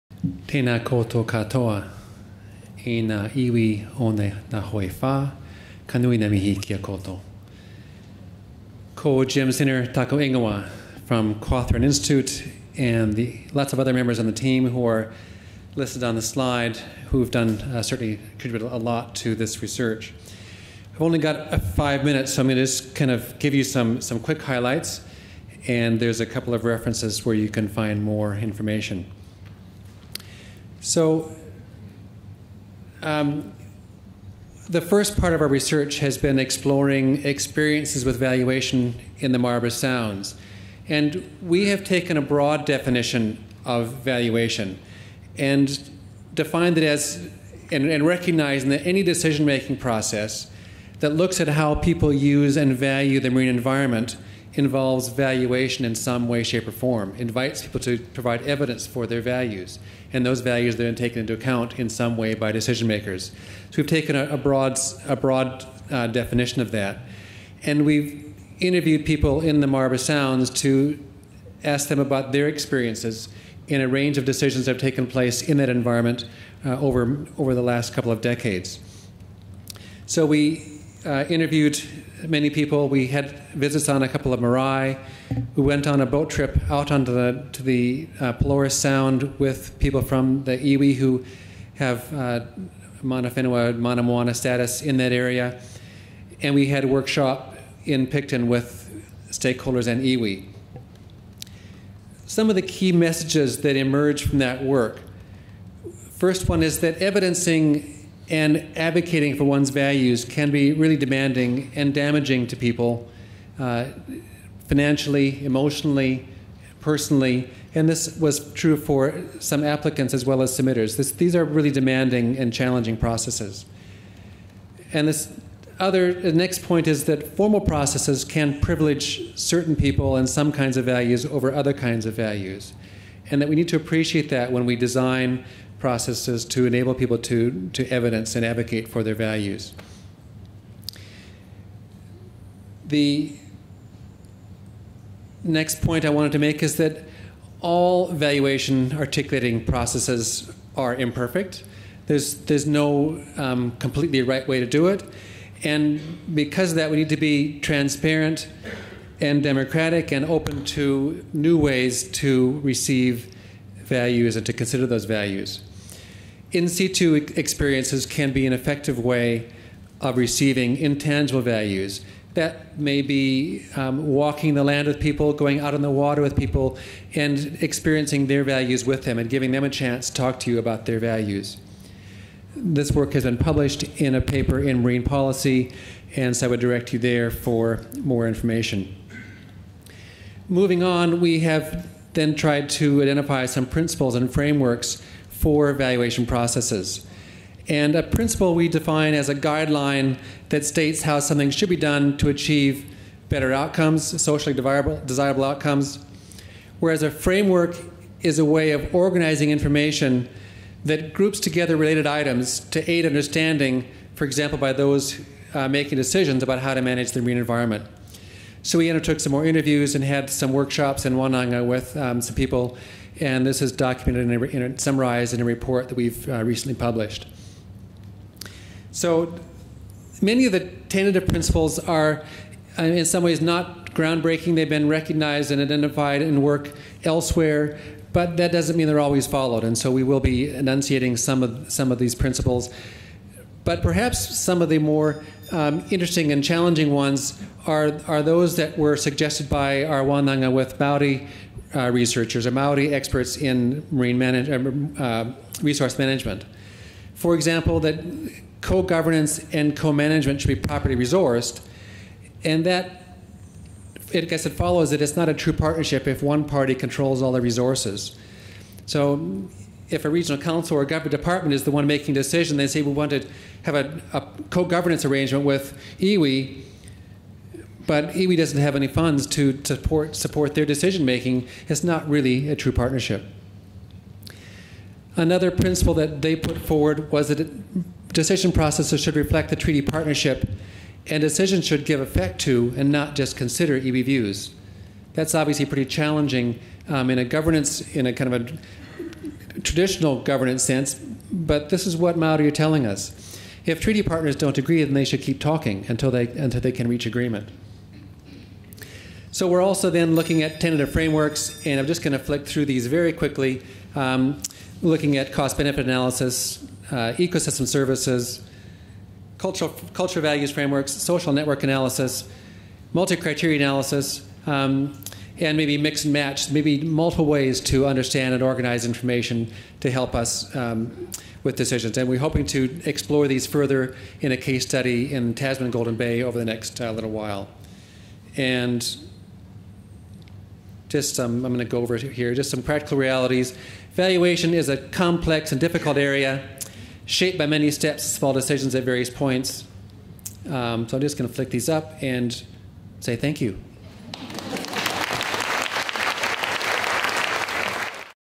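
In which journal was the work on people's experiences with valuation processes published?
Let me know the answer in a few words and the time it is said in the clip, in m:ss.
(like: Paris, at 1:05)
Marine Policy, at 3:04.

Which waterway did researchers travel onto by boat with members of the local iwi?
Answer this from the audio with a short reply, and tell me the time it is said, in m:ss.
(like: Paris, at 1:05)
Pelorus Sound, at 1:28.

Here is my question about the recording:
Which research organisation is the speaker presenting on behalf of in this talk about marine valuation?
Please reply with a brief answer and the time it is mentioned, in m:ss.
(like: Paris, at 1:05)
Cawthron Institute, at 0:11.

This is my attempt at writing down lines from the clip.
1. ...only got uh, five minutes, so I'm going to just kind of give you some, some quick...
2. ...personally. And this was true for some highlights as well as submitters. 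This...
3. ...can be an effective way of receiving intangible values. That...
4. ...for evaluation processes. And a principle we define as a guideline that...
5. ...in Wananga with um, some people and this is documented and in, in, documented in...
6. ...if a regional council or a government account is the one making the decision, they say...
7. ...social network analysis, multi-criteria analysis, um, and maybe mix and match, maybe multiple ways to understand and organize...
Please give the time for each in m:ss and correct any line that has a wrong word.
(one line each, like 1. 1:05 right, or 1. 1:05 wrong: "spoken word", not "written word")
1. 0:21 right
2. 1:56 wrong: "applicants", not "highlights"
3. 2:48 right
4. 3:15 right
5. 3:41 wrong: "summarized", not "documented"
6. 4:29 wrong: "department", not "account"
7. 5:20 right.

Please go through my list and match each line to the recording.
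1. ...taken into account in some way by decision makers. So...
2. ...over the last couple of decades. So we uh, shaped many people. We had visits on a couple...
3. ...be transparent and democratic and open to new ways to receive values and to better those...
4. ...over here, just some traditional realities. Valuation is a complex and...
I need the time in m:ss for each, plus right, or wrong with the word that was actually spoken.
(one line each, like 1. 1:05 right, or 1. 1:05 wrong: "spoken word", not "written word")
1. 1:00 right
2. 1:17 wrong: "interviewed", not "shaped"
3. 2:37 wrong: "consider", not "better"
4. 5:41 wrong: "practical", not "traditional".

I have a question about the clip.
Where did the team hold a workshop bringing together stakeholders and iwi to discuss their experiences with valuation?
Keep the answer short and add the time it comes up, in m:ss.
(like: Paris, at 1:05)
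Picton, at 1:38.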